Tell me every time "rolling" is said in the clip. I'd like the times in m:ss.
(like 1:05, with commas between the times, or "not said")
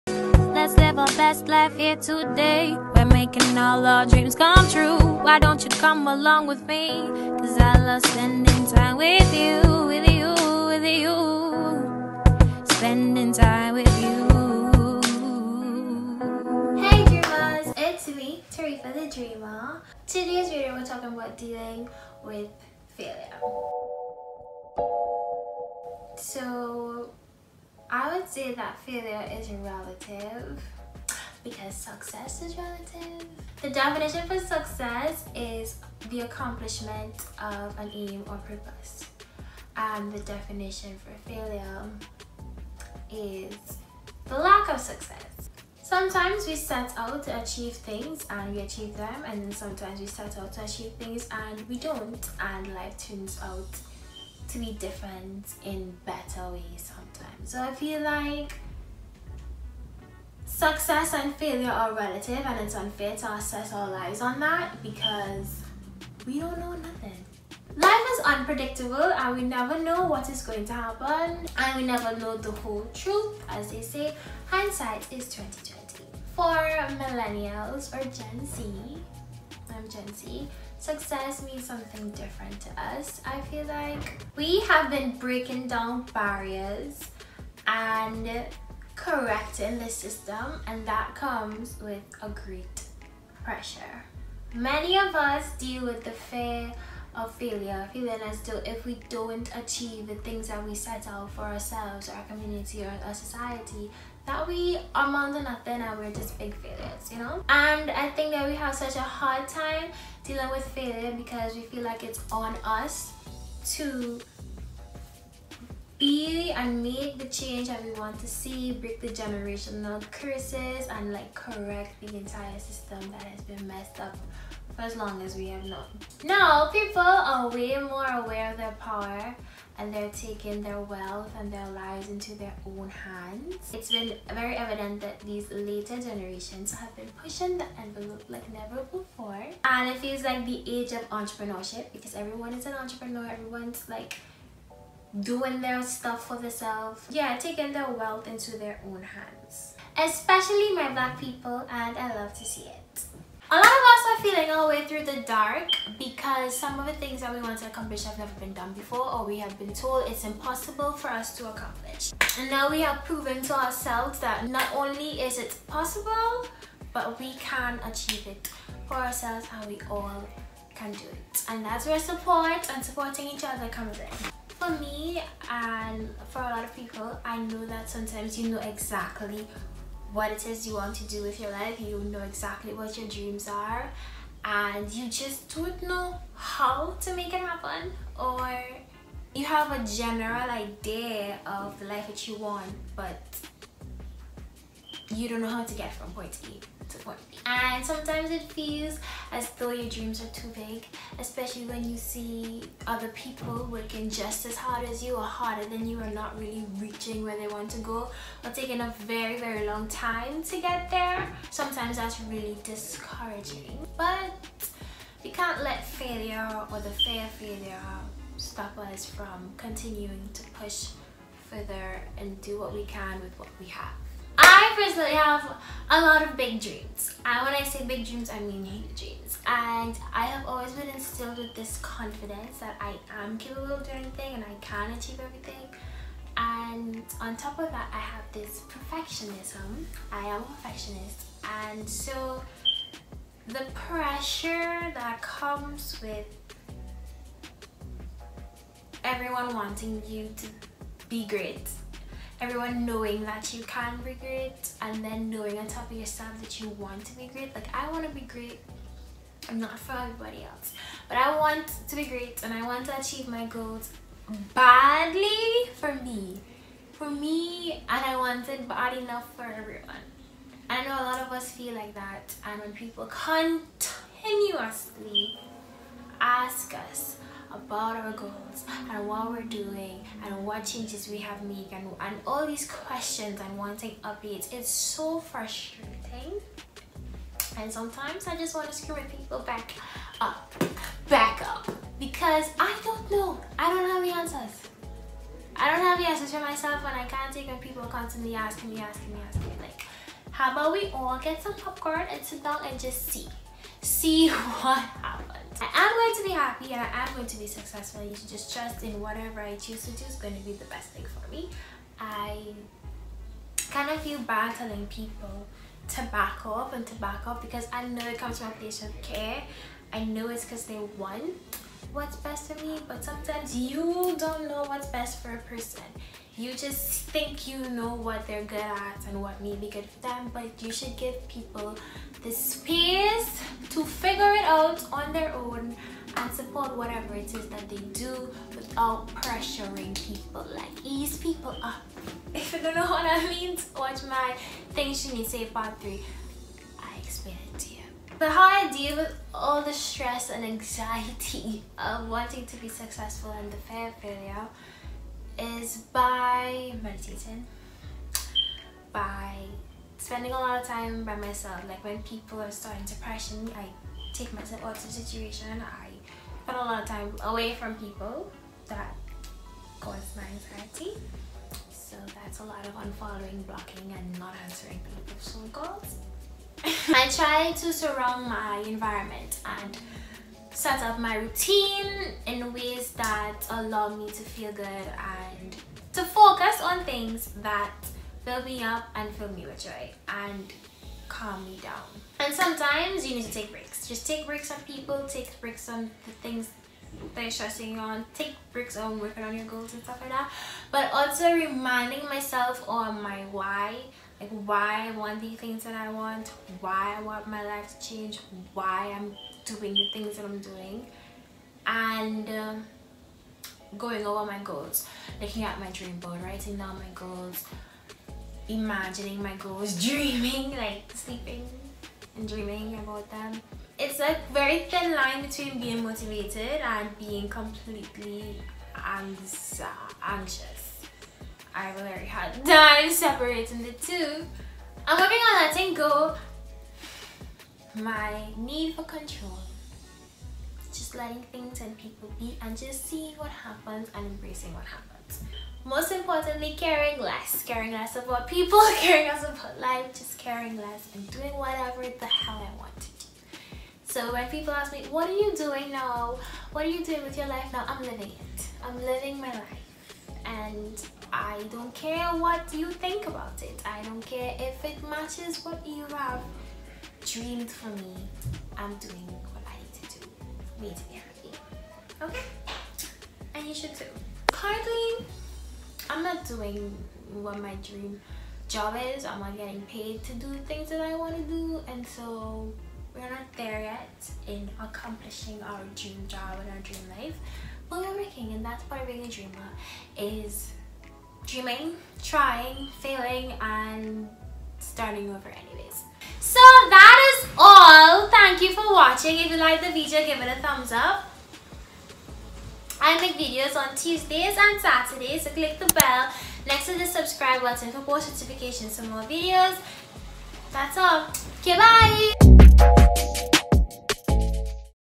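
not said.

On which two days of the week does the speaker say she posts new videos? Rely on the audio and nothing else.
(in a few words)
Tuesdays and Saturdays.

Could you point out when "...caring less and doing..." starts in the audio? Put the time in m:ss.
7:30.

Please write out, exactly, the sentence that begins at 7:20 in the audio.
Just letting things and people be and just seeing what happens and embracing what happens most importantly, caring less.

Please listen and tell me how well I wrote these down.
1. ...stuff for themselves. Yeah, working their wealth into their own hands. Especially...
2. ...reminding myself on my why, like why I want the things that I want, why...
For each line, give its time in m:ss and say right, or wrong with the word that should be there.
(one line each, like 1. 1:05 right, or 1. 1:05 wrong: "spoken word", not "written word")
1. 2:25 wrong: "taking", not "working"
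2. 6:41 right.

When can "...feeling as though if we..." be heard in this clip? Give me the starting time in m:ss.
1:37.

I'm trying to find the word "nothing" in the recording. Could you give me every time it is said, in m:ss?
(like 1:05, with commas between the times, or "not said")
1:06, 1:45.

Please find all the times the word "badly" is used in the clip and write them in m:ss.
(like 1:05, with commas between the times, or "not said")
4:24.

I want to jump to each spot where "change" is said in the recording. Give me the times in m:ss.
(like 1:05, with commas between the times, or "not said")
1:57, 4:40, 6:47.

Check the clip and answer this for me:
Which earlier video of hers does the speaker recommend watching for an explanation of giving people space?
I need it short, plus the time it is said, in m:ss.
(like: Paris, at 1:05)
Things need to Say Part 3, at 5:44.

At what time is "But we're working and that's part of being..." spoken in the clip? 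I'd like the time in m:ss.
8:07.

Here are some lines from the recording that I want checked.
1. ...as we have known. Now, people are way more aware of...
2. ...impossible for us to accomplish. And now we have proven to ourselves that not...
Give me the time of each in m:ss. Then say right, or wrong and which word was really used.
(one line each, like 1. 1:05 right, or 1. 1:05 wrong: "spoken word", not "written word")
1. 2:05 right
2. 2:40 right.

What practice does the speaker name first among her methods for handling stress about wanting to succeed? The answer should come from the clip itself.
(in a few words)
meditating.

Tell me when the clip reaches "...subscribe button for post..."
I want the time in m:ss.
8:26.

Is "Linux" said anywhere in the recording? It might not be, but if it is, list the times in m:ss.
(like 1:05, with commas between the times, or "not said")
not said.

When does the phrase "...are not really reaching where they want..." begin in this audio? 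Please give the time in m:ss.
3:25.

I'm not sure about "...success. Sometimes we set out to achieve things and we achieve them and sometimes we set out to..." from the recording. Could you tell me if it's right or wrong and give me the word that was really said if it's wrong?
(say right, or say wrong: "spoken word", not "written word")
right.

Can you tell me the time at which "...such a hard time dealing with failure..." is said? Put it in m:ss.
1:48.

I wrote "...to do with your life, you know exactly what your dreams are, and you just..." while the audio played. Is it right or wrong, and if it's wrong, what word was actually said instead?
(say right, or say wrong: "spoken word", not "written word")
right.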